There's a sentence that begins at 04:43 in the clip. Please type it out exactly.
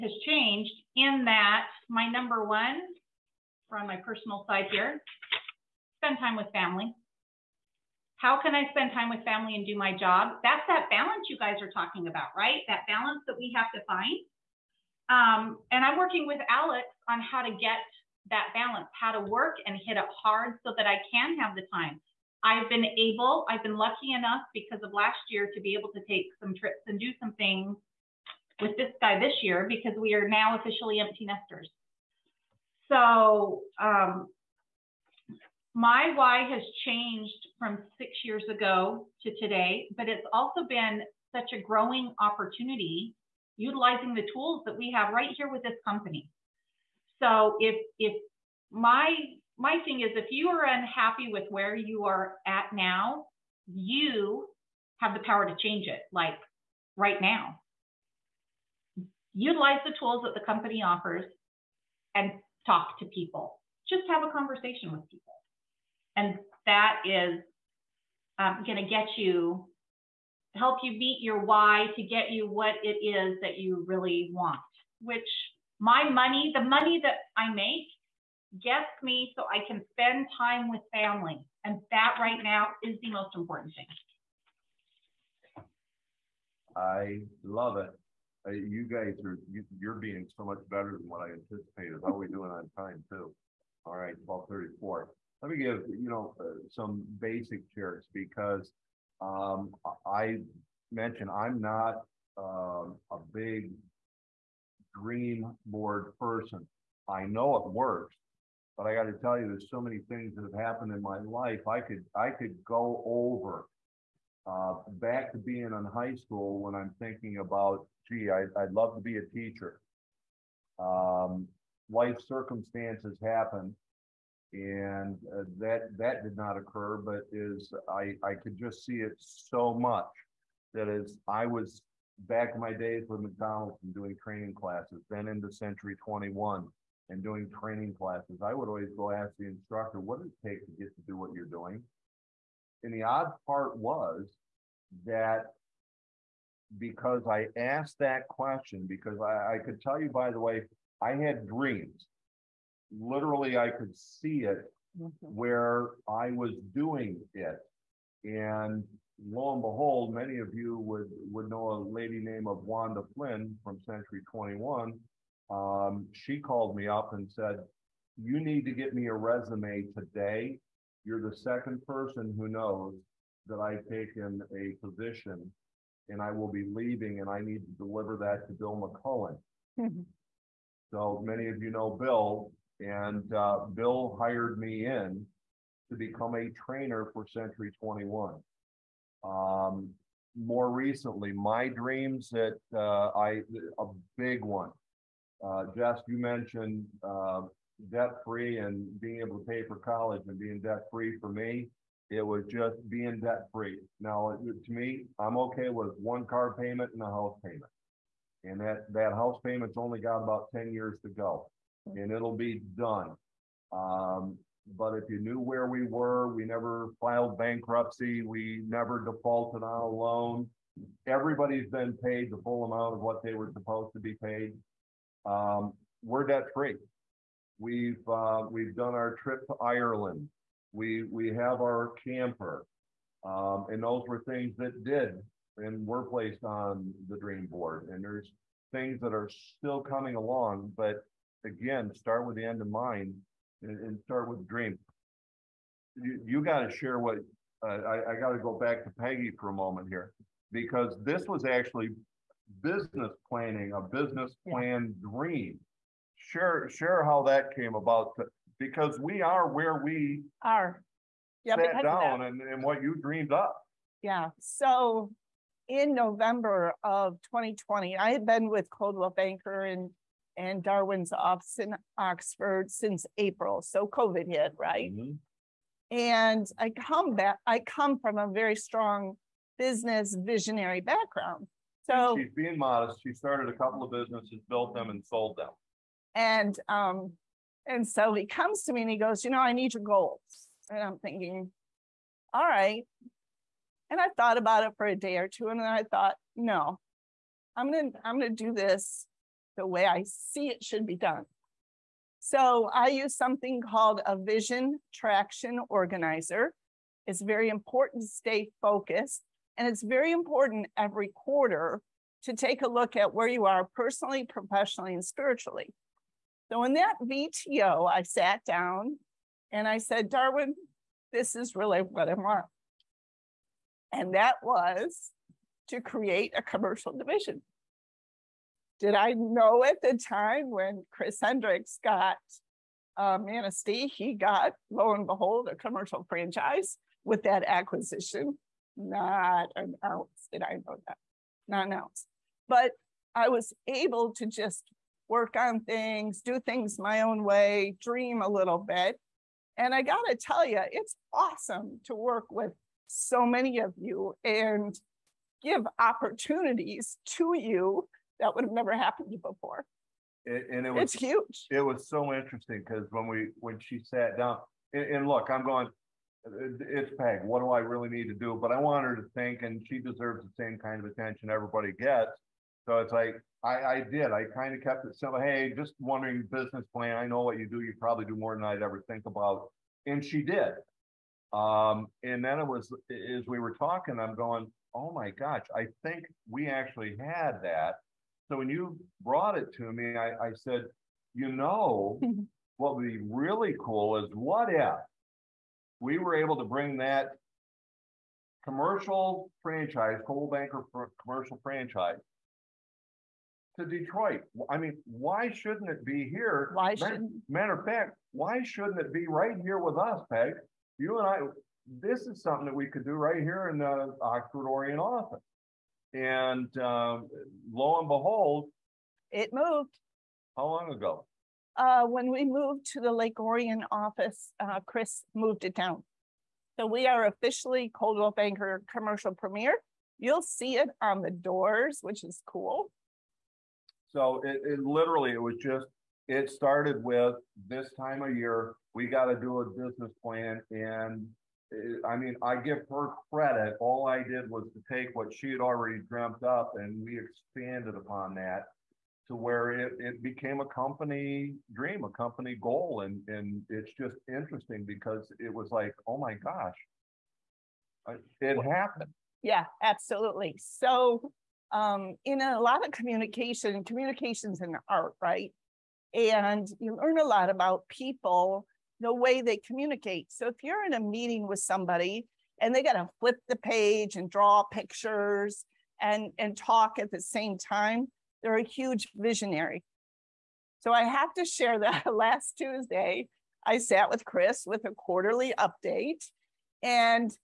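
She started a couple of businesses, built them, and sold them.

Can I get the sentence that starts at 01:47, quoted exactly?
I know it works, but I got to tell you, there's so many things that have happened in my life.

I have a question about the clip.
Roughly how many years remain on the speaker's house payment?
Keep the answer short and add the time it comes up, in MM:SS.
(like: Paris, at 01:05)
10 years, at 03:30.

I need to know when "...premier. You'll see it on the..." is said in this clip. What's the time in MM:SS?
07:09.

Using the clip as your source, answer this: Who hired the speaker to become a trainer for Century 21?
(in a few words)
Bill McCullen.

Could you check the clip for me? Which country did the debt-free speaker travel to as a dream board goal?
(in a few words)
Ireland.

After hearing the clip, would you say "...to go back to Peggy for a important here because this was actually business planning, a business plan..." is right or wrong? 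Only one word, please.
wrong.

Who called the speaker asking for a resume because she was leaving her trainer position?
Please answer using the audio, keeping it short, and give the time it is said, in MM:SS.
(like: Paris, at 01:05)
Wanda Flynn, at 02:42.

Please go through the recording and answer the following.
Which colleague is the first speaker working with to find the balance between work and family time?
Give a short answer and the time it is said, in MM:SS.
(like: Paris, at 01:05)
Alex, at 00:16.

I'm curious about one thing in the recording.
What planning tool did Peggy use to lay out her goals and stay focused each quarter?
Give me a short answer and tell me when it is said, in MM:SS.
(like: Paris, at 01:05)
Vision traction organizer, at 05:04.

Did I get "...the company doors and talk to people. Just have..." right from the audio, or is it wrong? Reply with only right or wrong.
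wrong.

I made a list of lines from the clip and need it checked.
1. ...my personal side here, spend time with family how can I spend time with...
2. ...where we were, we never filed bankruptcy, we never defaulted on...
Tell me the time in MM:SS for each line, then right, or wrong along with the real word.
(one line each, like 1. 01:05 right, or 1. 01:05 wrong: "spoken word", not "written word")
1. 00:03 right
2. 03:35 right.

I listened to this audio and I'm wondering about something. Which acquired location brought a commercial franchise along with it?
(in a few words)
Manistee.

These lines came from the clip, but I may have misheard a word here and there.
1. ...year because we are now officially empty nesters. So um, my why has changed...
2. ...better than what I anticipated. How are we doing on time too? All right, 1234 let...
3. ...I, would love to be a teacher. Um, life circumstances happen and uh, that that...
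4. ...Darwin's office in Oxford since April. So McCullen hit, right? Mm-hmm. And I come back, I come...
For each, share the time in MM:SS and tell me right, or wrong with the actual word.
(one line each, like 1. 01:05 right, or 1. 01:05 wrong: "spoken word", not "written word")
1. 00:29 right
2. 01:30 right
3. 01:58 right
4. 04:30 wrong: "COVID", not "McCullen".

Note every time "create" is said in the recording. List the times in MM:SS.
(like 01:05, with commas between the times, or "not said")
05:25.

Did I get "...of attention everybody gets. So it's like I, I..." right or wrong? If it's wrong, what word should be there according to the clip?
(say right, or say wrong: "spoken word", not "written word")
right.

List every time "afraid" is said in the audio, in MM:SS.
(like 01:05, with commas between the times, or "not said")
not said.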